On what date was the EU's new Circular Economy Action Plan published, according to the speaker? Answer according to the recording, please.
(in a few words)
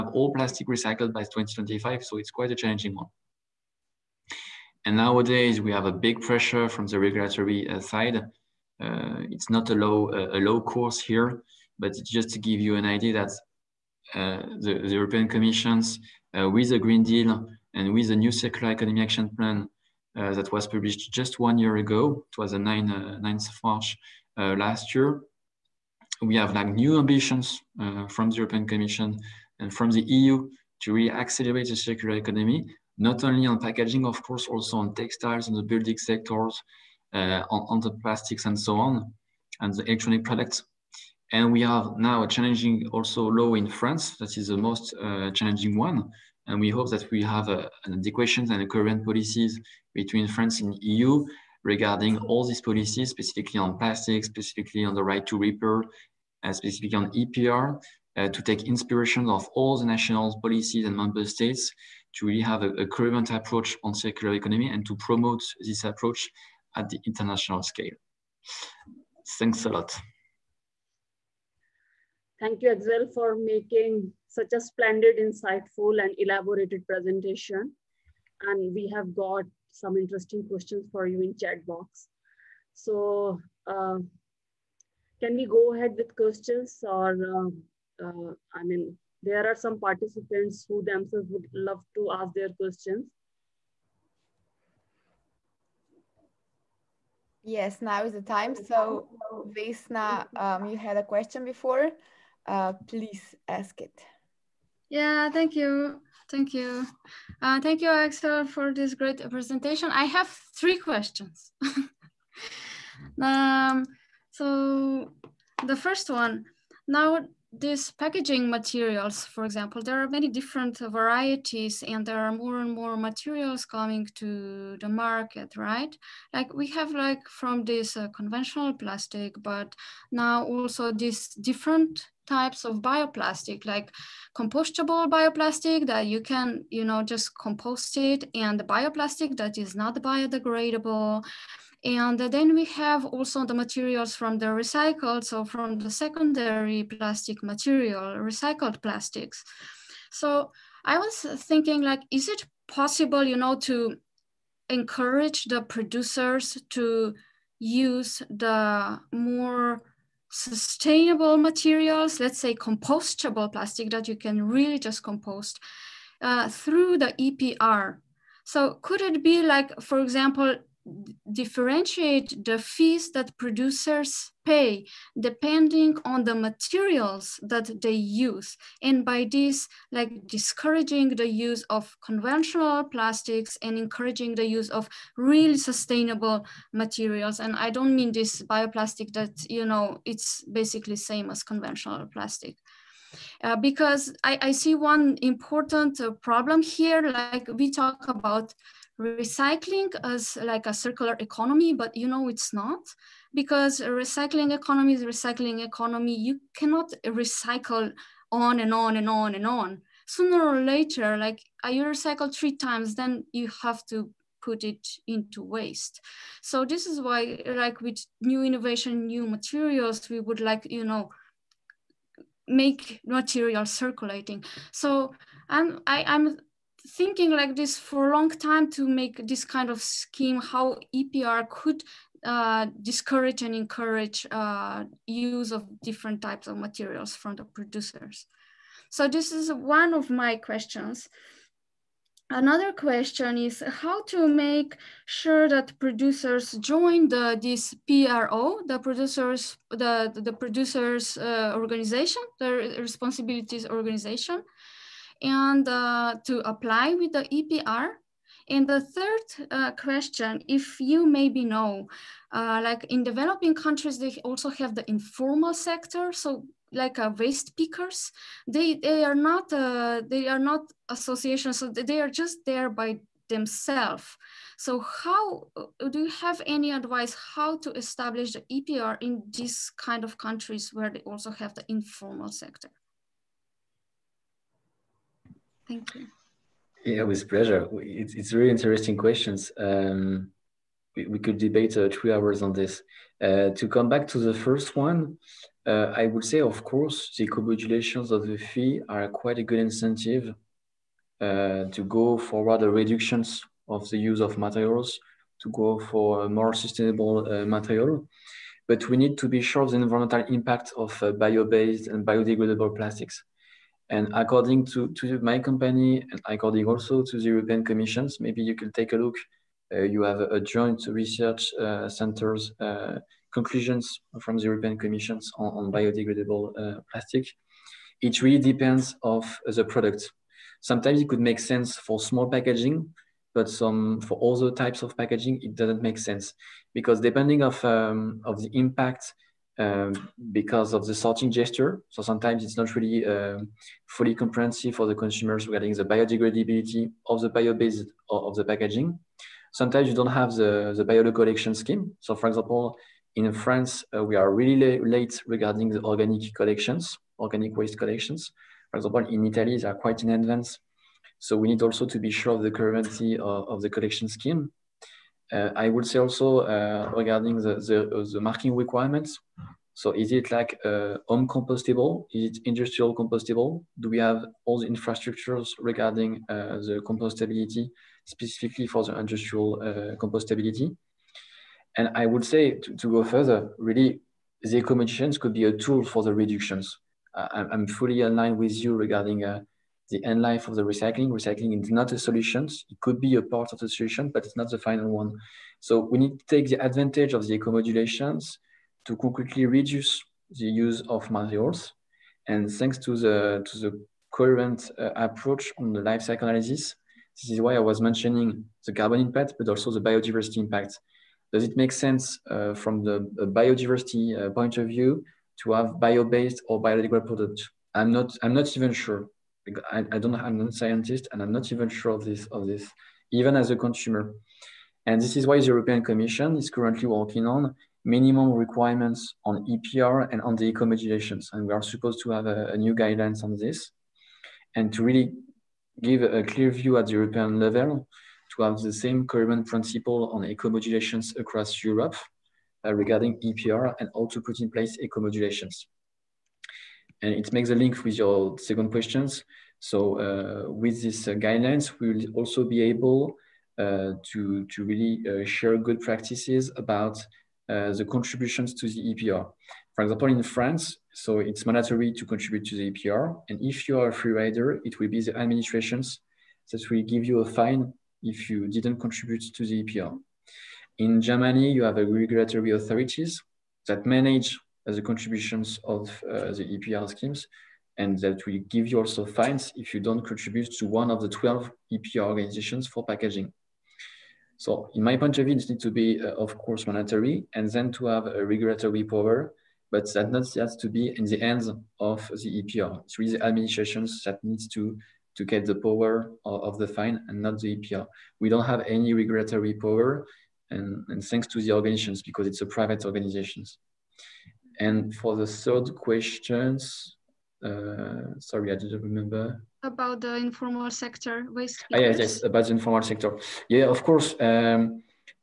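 9 March.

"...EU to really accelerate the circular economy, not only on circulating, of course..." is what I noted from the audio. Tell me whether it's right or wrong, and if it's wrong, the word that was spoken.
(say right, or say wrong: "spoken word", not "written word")
wrong: "packaging", not "circulating".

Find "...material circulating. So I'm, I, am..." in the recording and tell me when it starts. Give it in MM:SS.
03:43.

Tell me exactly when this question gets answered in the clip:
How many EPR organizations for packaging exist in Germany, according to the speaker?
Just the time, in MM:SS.
08:01.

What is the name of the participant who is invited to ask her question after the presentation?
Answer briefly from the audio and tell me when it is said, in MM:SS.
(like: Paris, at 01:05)
Vesna, at 01:39.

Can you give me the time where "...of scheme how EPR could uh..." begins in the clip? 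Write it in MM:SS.
03:49.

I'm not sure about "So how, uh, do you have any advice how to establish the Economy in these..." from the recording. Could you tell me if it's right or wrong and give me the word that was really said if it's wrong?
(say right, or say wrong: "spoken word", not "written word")
wrong: "EPR", not "Economy".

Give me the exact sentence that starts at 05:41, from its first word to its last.
So sometimes it's not really uh, fully comprehensive for the consumers regarding the biodegradability of the bio-based of the packaging.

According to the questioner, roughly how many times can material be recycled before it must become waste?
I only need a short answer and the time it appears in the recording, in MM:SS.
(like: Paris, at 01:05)
3, at 03:32.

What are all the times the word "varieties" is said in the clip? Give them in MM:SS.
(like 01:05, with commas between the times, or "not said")
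02:00.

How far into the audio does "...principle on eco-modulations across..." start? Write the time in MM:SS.
07:19.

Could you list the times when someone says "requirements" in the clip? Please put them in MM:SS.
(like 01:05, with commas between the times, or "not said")
06:08, 07:08.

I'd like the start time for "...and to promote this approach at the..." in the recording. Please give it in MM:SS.
01:04.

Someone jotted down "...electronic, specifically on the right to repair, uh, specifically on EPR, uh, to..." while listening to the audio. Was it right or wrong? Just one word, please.
wrong.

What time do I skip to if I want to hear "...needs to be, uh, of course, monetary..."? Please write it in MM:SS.
08:05.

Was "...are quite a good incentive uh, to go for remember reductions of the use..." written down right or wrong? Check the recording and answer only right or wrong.
wrong.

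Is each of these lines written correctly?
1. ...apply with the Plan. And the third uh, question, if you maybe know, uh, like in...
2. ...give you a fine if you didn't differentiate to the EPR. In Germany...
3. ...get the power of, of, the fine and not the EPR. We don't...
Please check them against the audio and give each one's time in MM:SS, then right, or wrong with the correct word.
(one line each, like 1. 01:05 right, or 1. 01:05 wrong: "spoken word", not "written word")
1. 04:16 wrong: "EPR", not "Plan"
2. 07:46 wrong: "contribute", not "differentiate"
3. 08:15 right.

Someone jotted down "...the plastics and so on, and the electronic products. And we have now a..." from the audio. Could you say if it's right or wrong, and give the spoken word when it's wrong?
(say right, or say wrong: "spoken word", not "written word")
right.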